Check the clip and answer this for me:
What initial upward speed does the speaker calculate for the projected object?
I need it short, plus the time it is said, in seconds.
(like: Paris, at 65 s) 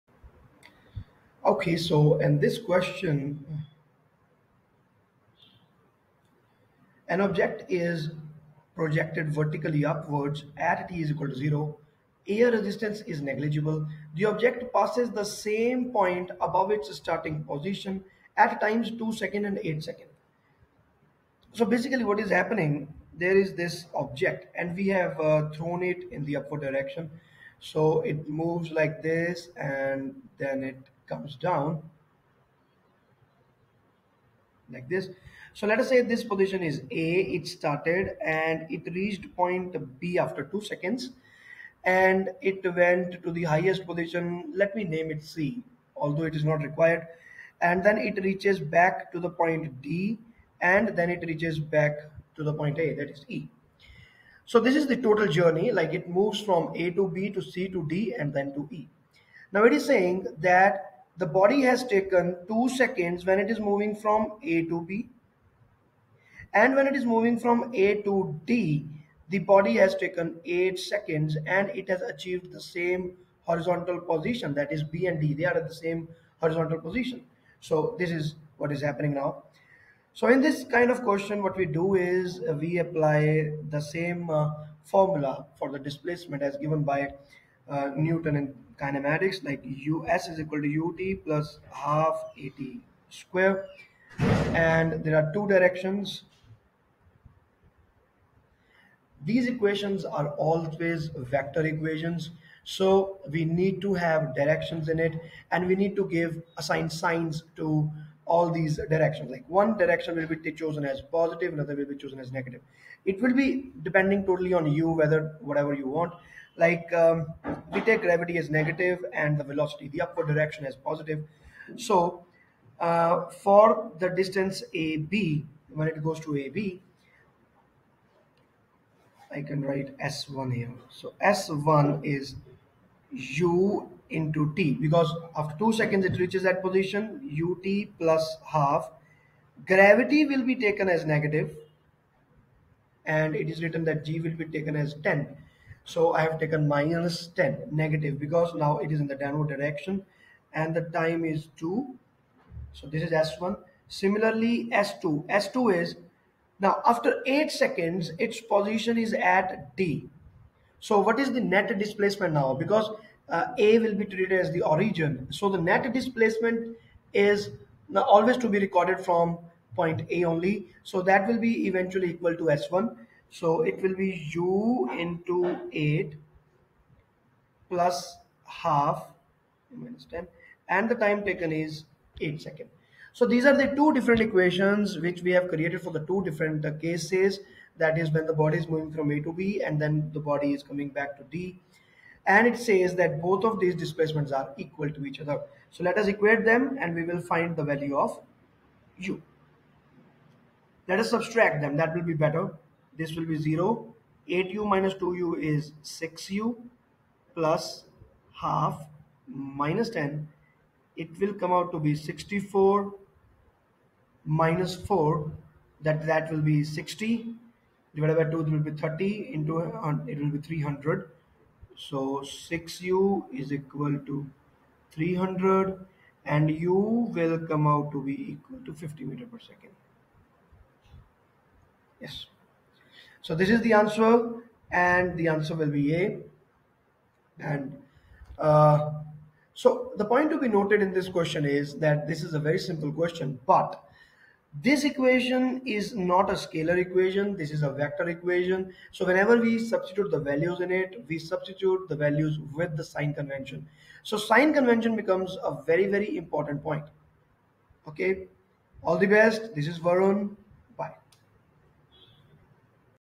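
50 meter per second, at 228 s.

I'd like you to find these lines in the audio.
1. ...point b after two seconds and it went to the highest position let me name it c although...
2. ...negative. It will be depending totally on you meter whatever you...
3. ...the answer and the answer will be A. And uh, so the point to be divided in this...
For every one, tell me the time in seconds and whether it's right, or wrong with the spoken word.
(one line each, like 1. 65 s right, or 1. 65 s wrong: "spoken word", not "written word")
1. 39 s right
2. 112 s wrong: "whether", not "meter"
3. 233 s wrong: "noted", not "divided".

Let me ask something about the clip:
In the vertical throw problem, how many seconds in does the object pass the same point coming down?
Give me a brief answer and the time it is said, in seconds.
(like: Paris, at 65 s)
8 seconds, at 19 s.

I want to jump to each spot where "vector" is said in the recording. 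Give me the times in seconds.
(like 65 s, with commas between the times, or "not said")
101 s, 247 s.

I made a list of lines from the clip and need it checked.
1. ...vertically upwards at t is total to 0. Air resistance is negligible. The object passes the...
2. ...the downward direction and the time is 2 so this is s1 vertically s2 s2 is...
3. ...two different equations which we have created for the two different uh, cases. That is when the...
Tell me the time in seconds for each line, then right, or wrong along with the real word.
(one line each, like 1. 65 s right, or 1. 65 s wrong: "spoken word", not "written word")
1. 9 s wrong: "equal", not "total"
2. 149 s wrong: "similarly", not "vertically"
3. 183 s right.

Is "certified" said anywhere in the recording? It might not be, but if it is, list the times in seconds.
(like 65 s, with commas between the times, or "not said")
not said.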